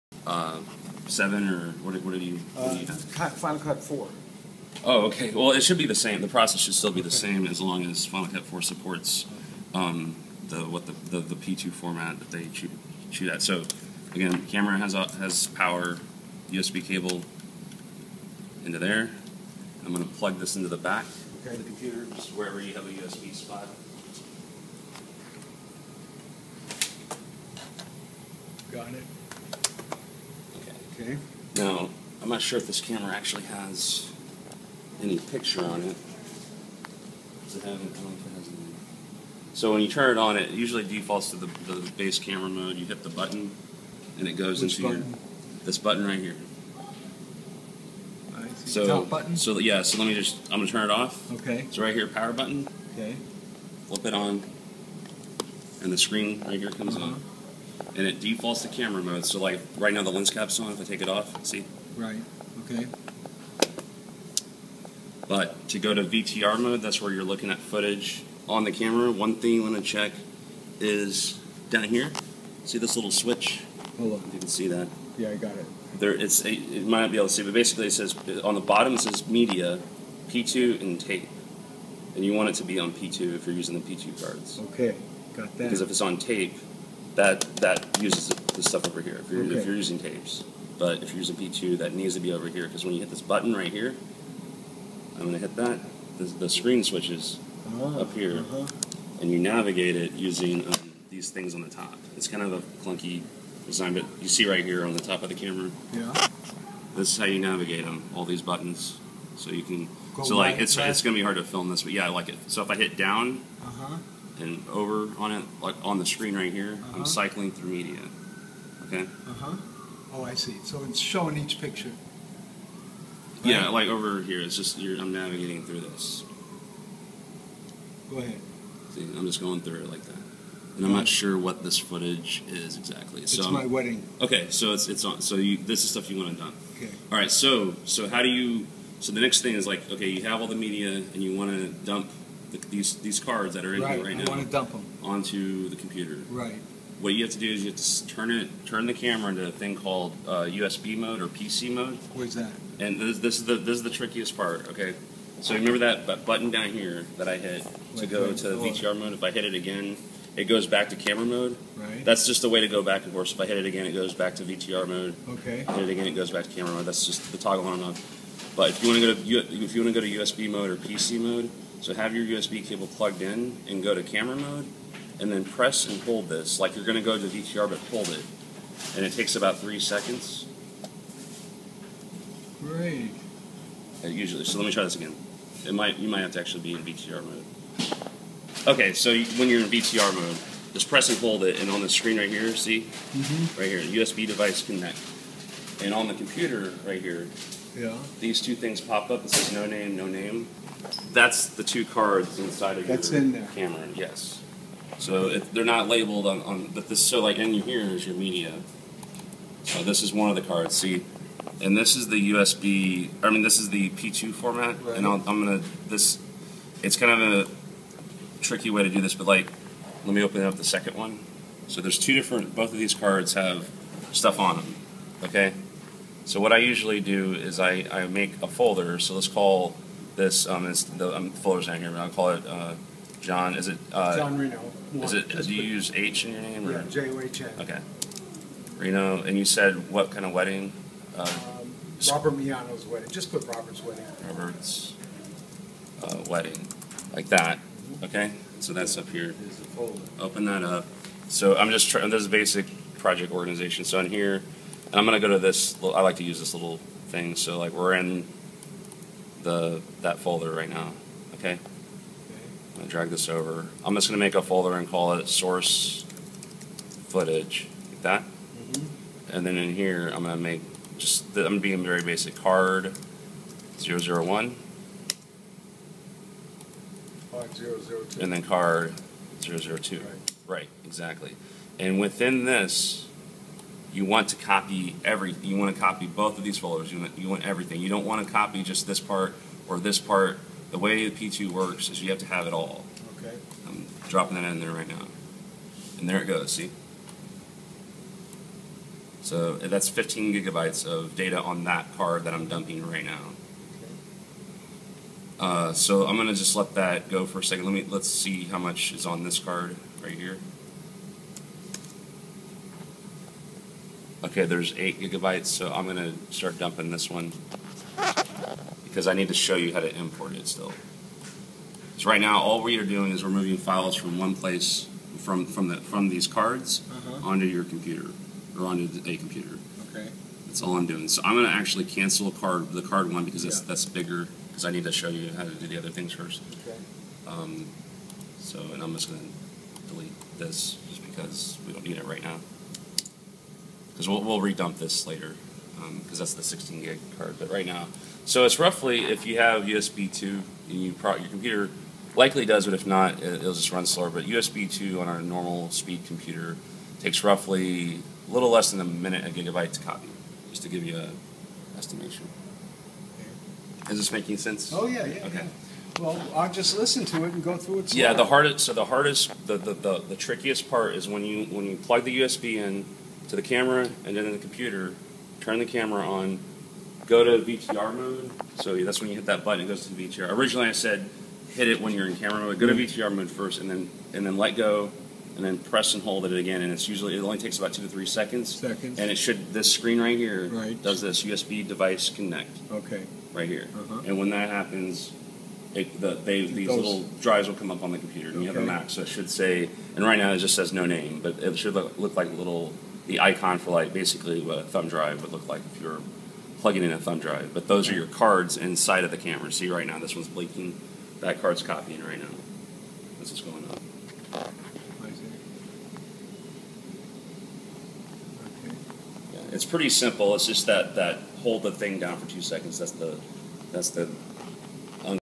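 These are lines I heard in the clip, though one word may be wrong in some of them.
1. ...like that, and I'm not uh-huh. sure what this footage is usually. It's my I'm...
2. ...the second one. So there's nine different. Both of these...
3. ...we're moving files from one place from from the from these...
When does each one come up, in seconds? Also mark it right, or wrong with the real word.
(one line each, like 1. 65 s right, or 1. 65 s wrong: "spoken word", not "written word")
1. 129 s wrong: "exactly", not "usually"
2. 220 s wrong: "two", not "nine"
3. 323 s right.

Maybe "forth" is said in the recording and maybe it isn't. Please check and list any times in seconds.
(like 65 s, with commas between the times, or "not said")
163 s.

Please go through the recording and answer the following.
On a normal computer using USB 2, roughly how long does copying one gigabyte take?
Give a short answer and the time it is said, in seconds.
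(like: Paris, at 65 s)
a little less than a minute, at 358 s.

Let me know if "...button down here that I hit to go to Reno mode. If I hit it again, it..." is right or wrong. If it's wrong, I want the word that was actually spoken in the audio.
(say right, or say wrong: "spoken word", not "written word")
wrong: "VTR", not "Reno".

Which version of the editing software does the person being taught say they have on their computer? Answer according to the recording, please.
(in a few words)
Final Cut 4.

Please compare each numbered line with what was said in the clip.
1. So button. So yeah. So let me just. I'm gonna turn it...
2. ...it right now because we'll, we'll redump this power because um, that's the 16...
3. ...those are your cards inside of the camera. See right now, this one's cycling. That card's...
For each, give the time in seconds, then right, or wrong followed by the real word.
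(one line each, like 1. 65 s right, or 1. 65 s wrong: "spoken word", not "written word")
1. 48 s right
2. 341 s wrong: "later", not "power"
3. 407 s wrong: "blinking", not "cycling".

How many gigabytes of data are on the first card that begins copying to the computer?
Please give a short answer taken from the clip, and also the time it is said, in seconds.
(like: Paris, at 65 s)
15, at 299 s.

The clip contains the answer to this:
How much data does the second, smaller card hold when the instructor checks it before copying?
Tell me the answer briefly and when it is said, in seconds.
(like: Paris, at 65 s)
8 gigabytes, at 314 s.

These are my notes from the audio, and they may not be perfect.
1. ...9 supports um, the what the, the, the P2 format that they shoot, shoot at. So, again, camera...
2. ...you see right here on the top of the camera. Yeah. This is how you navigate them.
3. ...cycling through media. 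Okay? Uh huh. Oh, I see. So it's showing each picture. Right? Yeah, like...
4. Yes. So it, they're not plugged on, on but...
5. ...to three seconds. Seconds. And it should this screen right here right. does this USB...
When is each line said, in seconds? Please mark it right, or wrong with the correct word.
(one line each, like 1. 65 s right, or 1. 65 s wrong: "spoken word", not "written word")
1. 8 s wrong: "4", not "9"
2. 104 s right
3. 117 s right
4. 203 s wrong: "labeled", not "plugged"
5. 387 s right.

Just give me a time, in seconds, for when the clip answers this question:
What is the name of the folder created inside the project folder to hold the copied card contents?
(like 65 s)
265 s.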